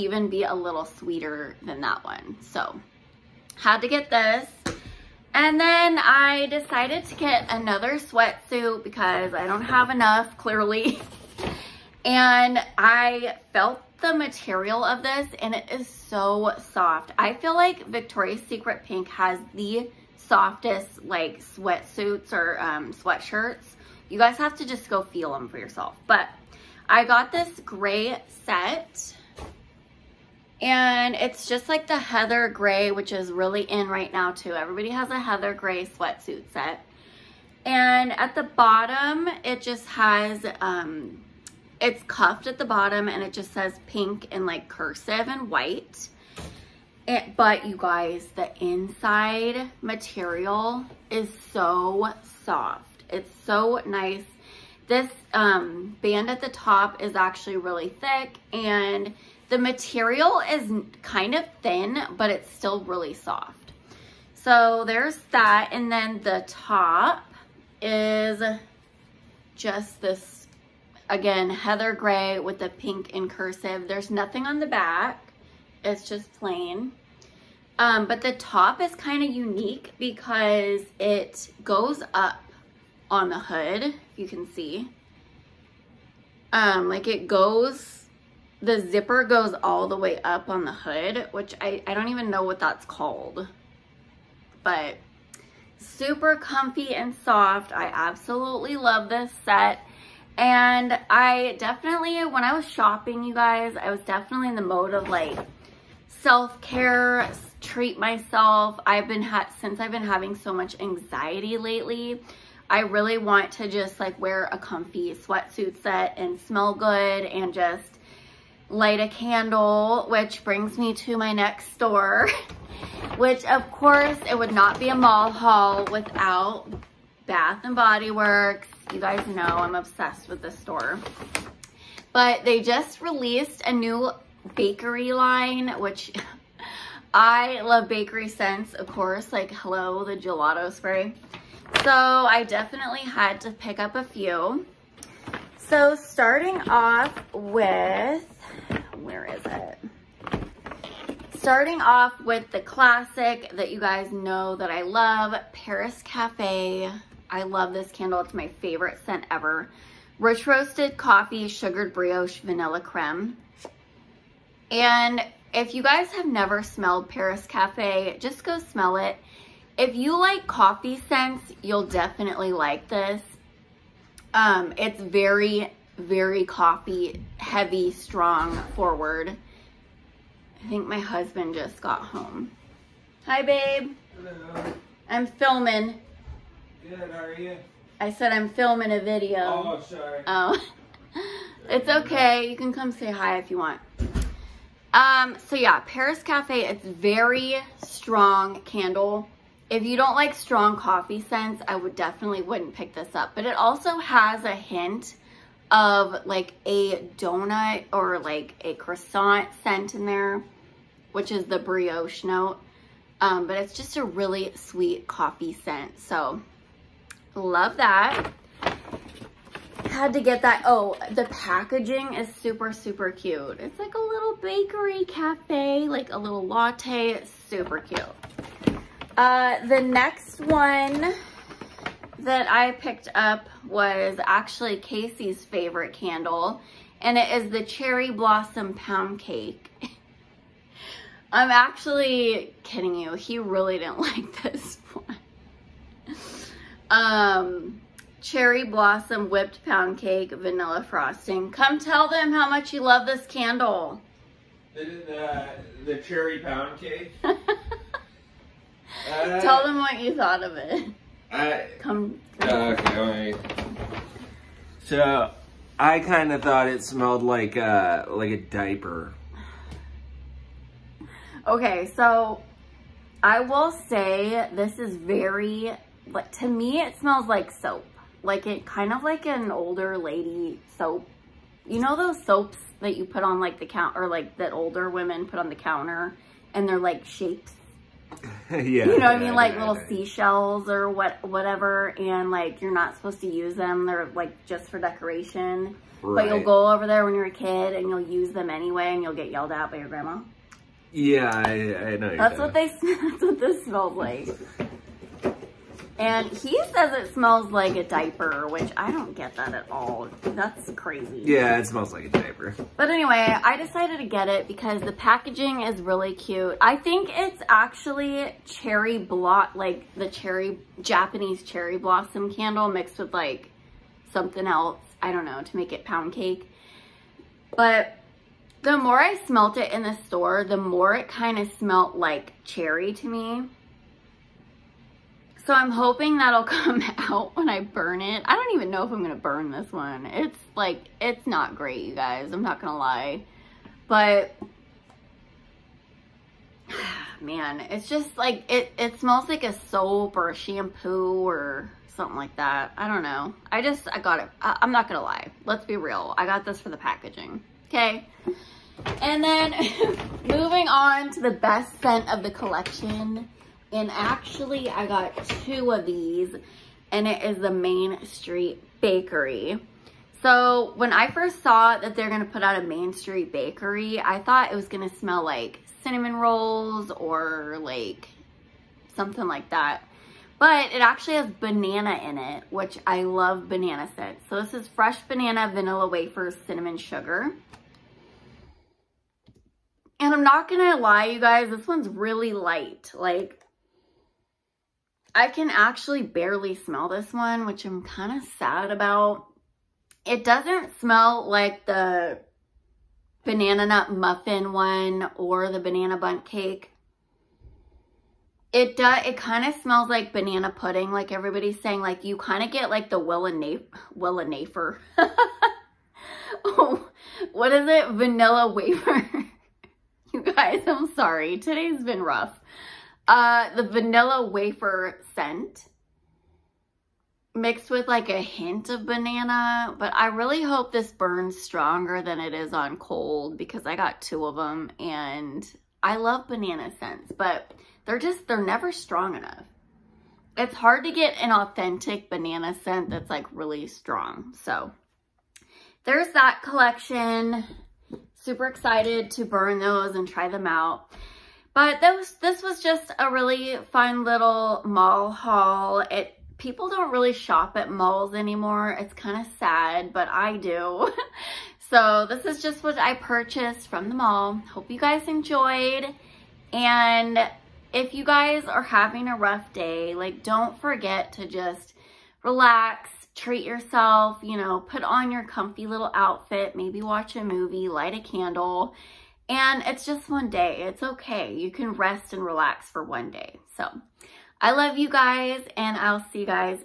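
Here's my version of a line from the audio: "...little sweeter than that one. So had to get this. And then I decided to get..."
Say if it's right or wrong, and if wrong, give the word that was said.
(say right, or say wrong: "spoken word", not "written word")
right.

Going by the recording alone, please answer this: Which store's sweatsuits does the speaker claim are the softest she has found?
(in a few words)
Victoria's Secret Pink.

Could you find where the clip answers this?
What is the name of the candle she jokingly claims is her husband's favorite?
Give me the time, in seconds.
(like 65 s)
237 s.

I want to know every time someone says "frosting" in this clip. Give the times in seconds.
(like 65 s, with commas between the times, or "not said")
250 s.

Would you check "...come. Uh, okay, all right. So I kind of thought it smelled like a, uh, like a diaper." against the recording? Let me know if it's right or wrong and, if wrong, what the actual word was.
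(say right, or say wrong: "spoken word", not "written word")
right.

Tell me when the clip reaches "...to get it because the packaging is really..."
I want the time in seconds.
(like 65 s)
313 s.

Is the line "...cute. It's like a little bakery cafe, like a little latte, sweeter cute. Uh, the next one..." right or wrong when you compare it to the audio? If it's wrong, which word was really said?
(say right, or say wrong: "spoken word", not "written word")
wrong: "super", not "sweeter".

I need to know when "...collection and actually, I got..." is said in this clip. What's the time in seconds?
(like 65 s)
362 s.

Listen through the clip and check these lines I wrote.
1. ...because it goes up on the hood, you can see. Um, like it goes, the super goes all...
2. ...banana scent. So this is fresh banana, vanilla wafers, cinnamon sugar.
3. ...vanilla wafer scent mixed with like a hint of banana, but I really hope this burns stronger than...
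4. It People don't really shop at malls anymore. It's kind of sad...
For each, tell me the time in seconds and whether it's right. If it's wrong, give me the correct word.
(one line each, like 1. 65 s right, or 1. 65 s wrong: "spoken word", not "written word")
1. 79 s wrong: "zipper", not "super"
2. 383 s right
3. 423 s right
4. 455 s right.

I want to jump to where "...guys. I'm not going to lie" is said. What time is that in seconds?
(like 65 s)
341 s.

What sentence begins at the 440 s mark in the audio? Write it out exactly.
It's hard to get an authentic banana scent that's like really strong.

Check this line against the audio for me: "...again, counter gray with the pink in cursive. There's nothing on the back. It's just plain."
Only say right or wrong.
wrong.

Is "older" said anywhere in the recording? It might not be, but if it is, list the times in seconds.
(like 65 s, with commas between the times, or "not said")
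279 s, 284 s.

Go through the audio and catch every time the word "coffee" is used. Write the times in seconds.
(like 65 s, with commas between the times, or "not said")
160 s, 170 s, 176 s, 200 s, 215 s.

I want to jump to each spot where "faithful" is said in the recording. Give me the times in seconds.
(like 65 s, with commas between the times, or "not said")
not said.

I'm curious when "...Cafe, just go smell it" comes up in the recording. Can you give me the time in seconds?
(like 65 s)
167 s.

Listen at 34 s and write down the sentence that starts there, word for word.
Everybody has a heather gray sweatsuit set.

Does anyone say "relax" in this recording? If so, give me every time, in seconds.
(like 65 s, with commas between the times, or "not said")
472 s, 482 s.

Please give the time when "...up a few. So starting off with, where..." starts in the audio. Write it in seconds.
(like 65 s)
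143 s.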